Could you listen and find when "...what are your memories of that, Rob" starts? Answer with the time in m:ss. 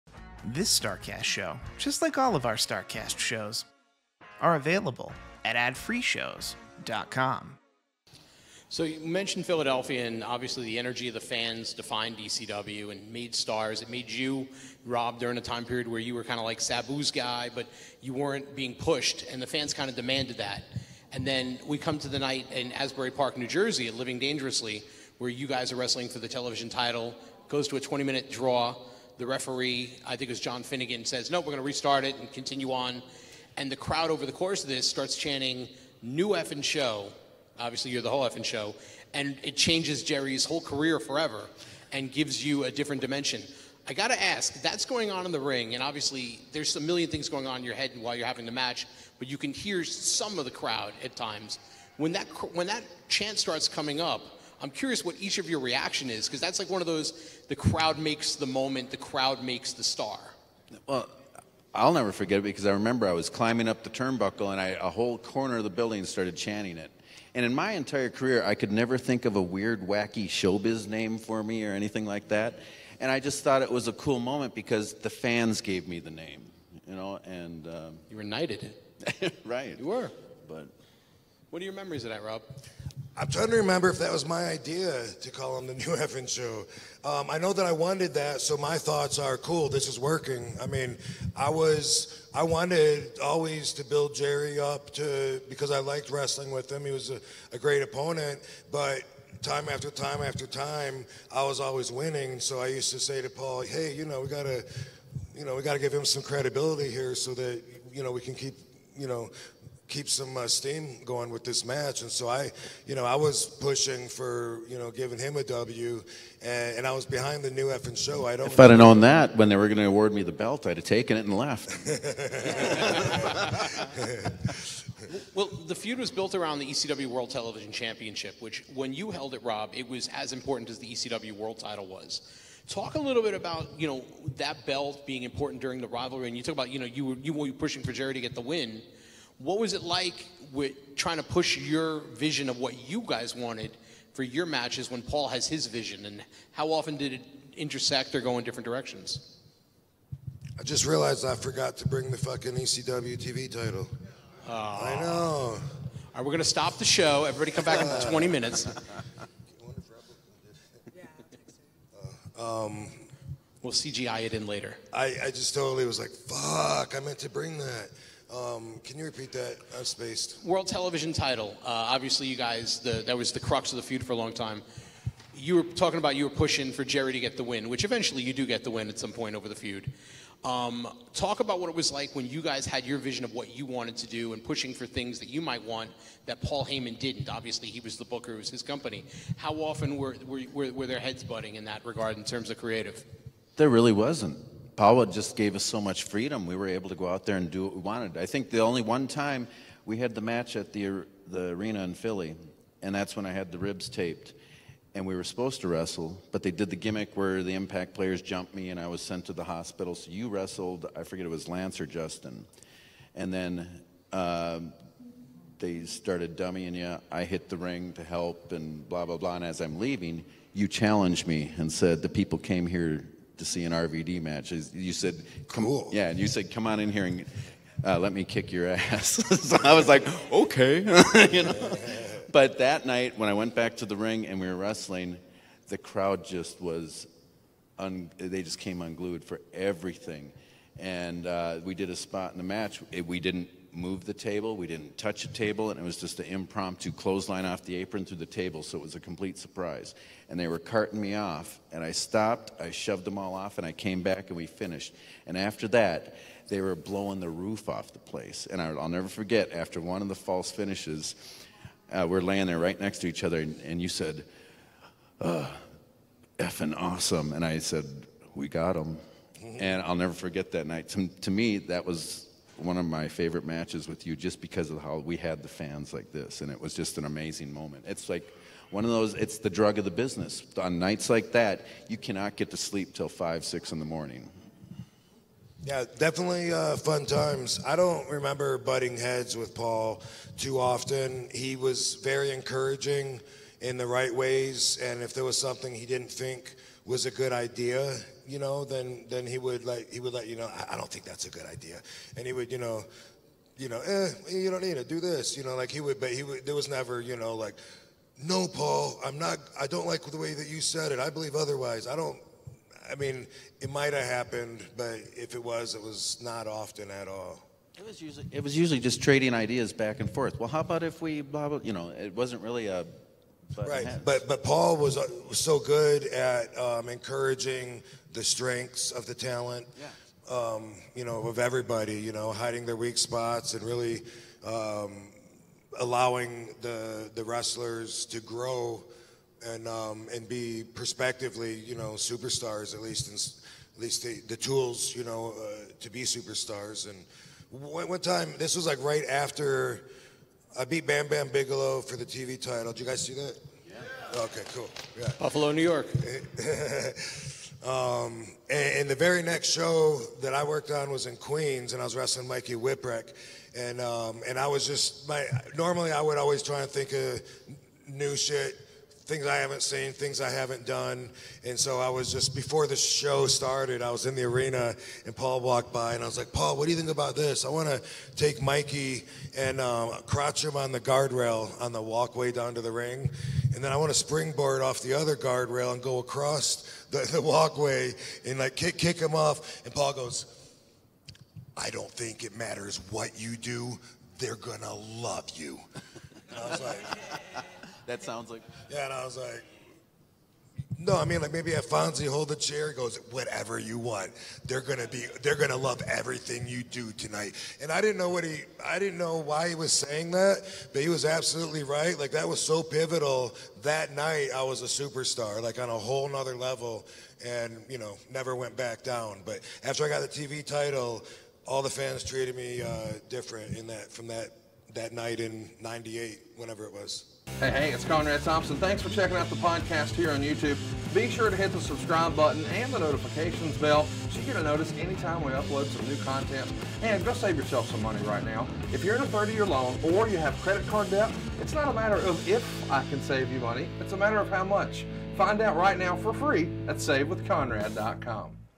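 1:21.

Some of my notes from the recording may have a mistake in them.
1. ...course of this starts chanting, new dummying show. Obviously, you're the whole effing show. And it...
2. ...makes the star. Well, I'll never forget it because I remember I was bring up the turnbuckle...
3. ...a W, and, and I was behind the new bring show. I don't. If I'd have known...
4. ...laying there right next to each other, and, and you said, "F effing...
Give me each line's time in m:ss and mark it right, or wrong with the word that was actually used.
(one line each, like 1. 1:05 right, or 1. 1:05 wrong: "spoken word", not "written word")
1. 0:34 wrong: "effing", not "dummying"
2. 0:59 wrong: "climbing", not "bring"
3. 1:55 wrong: "effing", not "bring"
4. 4:22 right.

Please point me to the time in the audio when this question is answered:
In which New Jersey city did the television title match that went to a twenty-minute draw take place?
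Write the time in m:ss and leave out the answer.
0:22.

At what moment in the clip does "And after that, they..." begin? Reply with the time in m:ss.
4:15.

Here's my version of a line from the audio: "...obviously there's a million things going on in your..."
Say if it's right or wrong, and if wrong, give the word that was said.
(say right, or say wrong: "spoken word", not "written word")
right.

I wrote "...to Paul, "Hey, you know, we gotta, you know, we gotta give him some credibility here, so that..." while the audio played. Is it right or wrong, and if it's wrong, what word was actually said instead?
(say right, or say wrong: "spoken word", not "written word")
right.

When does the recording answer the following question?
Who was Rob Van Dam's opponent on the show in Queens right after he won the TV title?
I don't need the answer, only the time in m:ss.
6:02.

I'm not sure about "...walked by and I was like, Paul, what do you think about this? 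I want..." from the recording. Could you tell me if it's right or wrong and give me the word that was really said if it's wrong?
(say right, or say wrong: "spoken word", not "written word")
right.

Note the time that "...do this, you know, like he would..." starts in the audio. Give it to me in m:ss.
5:04.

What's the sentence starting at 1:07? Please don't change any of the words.
And in my entire career, I could never think of a weird, wacky showbiz name for me or anything like that.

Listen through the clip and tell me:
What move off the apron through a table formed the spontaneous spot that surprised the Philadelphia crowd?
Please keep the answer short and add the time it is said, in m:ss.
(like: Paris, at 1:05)
Clothesline, at 4:06.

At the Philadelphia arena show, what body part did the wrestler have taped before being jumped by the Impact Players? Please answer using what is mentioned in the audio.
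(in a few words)
Ribs.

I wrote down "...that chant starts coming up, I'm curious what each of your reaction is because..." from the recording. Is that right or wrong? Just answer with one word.
right.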